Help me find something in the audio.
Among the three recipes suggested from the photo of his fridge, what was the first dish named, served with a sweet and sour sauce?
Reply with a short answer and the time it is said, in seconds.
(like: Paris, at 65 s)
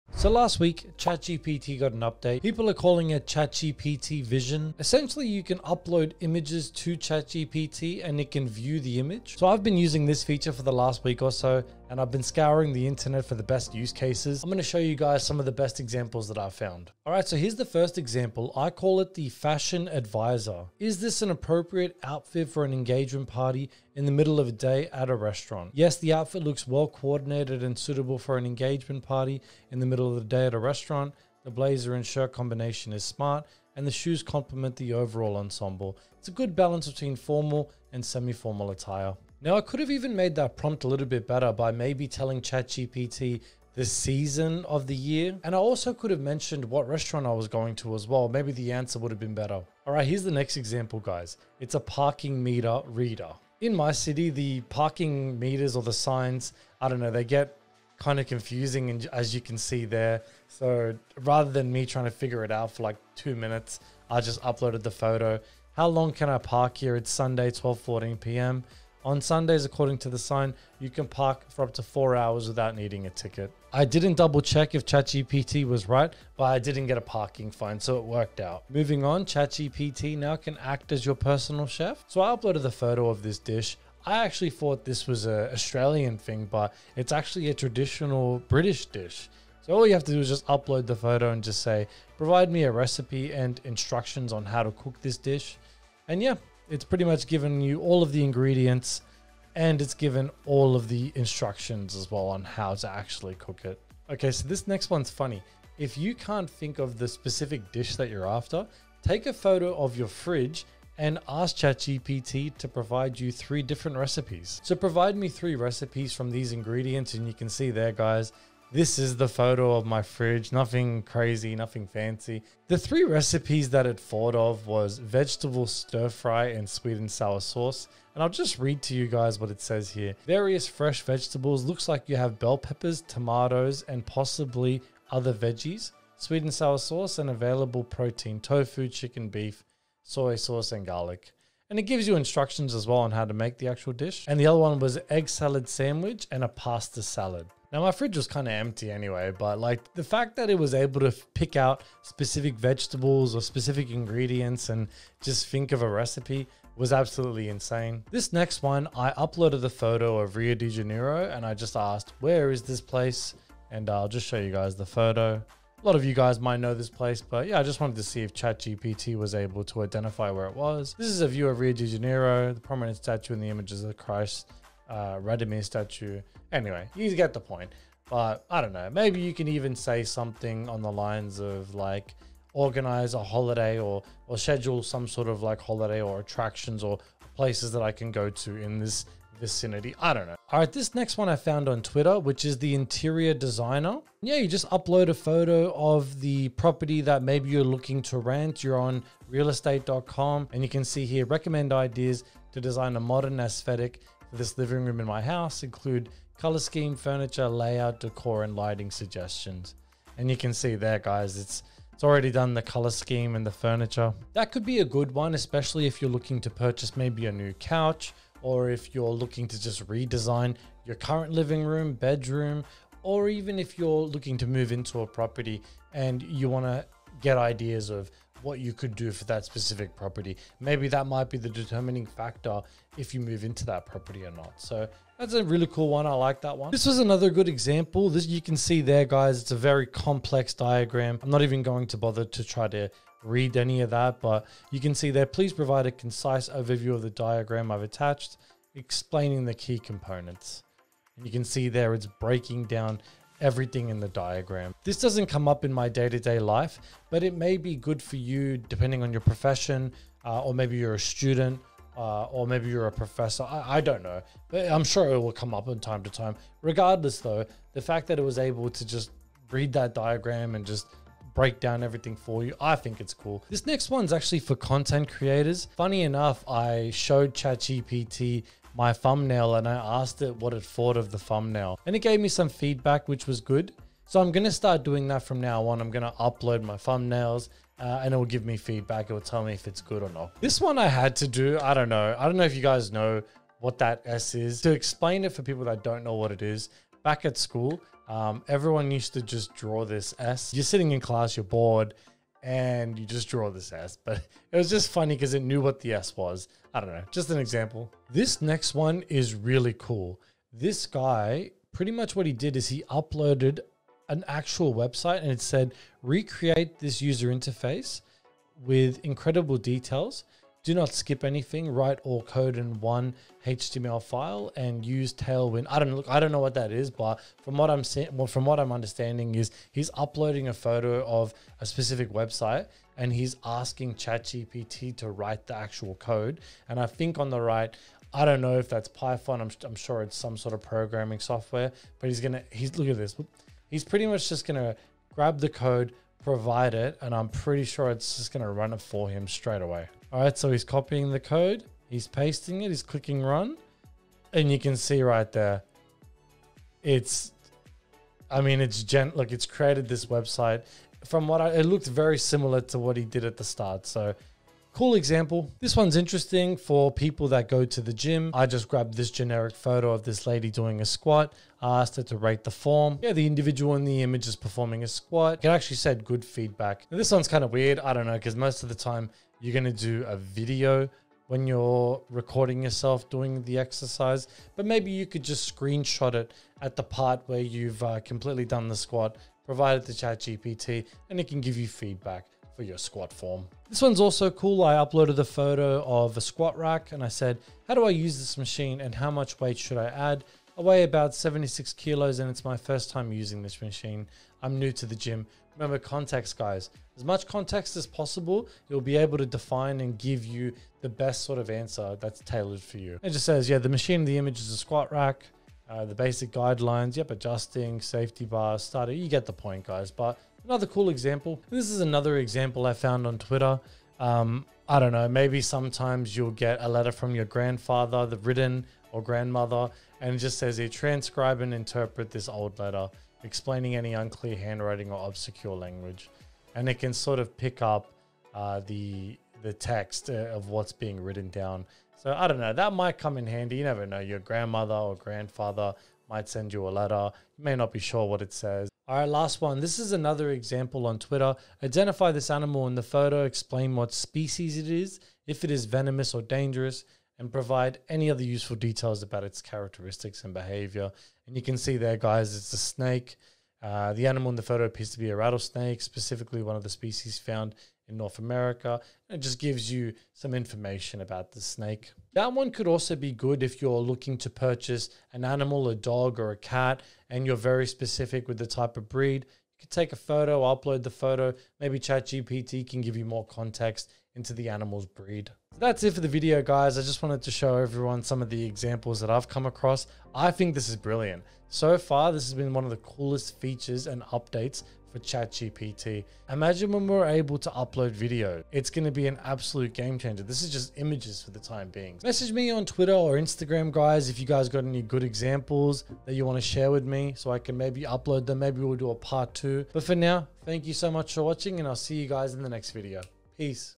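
Vegetable stir fry, at 124 s.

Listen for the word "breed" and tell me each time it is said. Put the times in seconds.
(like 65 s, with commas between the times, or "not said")
478 s, 484 s.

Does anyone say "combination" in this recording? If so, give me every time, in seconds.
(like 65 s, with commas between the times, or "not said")
32 s.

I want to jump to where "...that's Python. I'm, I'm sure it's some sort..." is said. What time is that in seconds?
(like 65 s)
338 s.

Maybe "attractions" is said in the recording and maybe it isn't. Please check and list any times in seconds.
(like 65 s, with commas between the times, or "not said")
186 s.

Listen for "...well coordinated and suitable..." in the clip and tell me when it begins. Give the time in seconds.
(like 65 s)
26 s.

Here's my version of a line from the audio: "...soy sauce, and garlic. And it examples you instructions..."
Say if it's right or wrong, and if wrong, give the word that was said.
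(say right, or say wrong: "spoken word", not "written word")
wrong: "gives", not "examples".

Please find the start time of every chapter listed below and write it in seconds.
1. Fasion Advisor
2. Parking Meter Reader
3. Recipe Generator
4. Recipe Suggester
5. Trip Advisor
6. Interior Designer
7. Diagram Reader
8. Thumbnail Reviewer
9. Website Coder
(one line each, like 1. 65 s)
1. 17 s
2. 49 s
3. 78 s
4. 104 s
5. 158 s
6. 192 s
7. 236 s
8. 273 s
9. 308 s.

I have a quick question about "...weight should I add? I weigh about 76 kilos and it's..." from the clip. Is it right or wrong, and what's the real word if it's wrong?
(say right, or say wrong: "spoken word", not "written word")
right.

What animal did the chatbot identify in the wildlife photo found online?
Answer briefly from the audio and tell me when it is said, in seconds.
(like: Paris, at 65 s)
Rattlesnake, at 465 s.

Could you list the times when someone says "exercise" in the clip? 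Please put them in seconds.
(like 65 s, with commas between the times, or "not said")
383 s.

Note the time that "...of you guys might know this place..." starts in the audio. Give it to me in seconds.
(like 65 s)
165 s.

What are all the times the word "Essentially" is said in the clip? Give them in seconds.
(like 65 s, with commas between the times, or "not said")
4 s.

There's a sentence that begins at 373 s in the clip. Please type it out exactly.
Yeah, the individual in the image is performing a squat.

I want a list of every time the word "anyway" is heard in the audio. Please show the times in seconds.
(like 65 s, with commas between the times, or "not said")
148 s, 176 s.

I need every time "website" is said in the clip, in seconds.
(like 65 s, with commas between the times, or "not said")
314 s, 332 s, 360 s.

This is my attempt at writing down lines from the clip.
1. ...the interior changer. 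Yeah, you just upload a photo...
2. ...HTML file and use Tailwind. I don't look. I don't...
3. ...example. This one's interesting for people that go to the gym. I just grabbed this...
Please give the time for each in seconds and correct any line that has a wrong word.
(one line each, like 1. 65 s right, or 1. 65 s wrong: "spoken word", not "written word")
1. 192 s wrong: "designer", not "changer"
2. 323 s right
3. 364 s right.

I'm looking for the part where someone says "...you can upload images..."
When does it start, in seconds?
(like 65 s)
5 s.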